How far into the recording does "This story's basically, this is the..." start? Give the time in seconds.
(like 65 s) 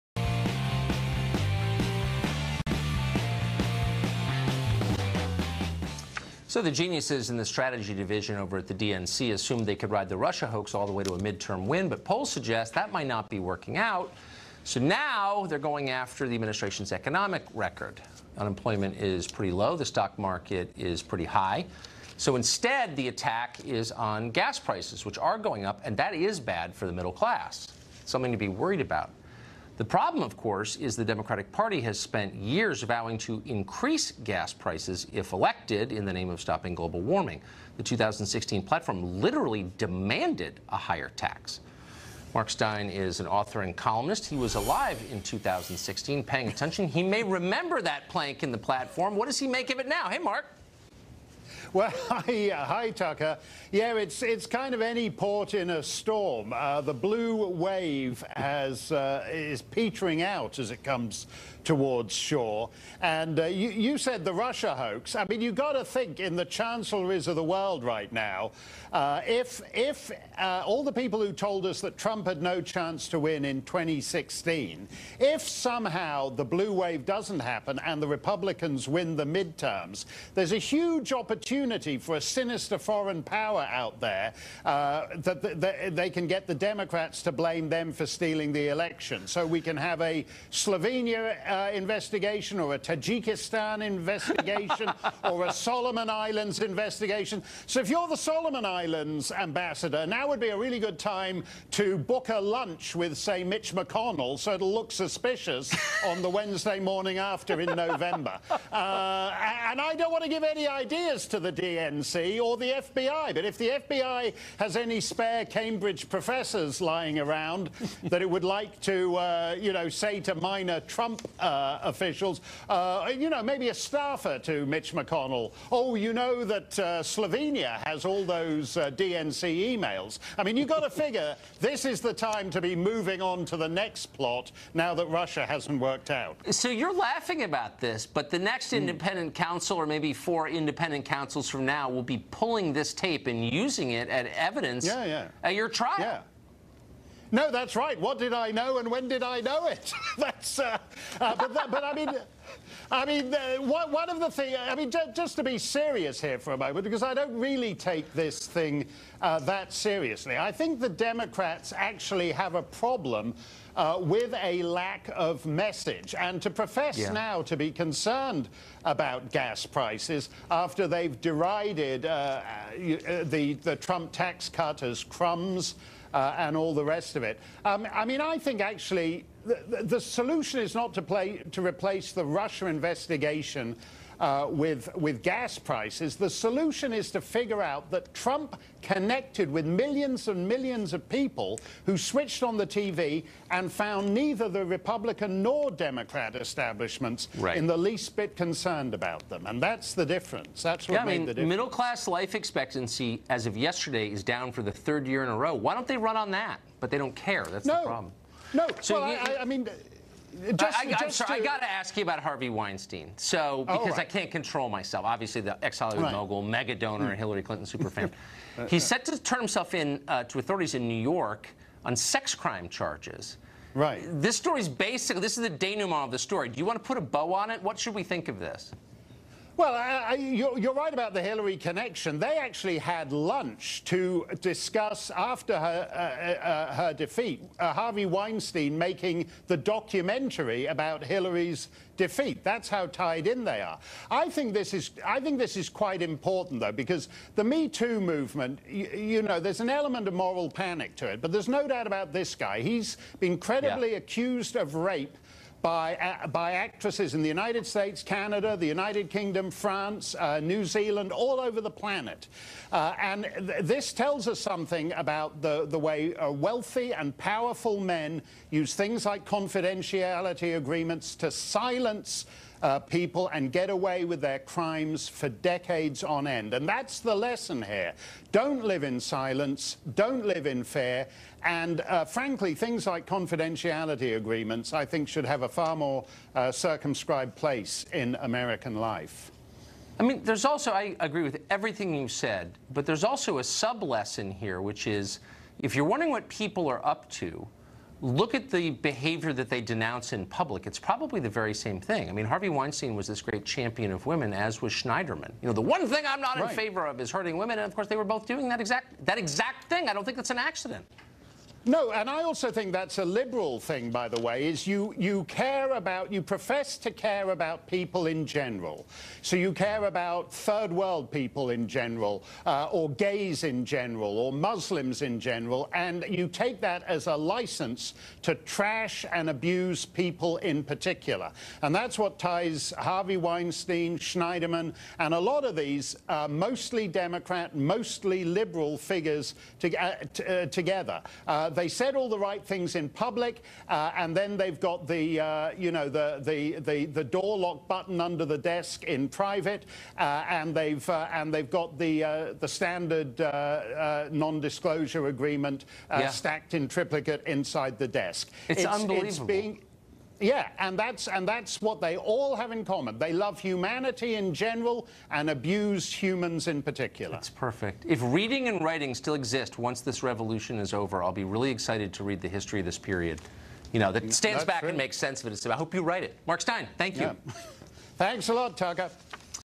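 224 s.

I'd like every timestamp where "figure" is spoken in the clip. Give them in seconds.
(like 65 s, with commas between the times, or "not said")
130 s, 187 s, 338 s.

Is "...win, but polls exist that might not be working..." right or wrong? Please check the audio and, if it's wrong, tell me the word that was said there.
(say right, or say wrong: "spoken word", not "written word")
wrong: "suggest", not "exist".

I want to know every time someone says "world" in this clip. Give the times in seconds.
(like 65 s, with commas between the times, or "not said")
67 s, 320 s.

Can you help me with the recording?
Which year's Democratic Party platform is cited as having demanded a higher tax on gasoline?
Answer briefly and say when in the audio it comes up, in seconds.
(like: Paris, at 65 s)
2016, at 37 s.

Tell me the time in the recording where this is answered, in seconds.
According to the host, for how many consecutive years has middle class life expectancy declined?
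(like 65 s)
204 s.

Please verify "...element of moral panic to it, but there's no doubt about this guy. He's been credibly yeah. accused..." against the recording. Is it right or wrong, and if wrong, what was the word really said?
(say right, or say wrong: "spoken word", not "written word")
right.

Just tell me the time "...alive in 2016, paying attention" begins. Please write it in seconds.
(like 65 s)
44 s.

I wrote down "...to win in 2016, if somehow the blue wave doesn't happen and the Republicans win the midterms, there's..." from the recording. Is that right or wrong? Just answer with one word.
right.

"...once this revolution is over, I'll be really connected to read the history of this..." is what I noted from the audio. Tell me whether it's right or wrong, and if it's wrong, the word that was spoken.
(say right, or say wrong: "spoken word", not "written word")
wrong: "excited", not "connected".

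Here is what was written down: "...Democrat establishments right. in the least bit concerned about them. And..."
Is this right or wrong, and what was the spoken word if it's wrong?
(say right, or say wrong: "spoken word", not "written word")
right.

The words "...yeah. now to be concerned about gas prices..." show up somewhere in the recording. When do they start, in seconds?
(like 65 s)
166 s.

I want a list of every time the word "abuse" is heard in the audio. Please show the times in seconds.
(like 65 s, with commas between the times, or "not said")
329 s, 365 s.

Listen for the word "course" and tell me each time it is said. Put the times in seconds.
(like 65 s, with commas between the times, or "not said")
30 s, 307 s.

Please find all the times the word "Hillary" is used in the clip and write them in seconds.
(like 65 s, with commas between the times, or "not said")
217 s, 231 s, 241 s.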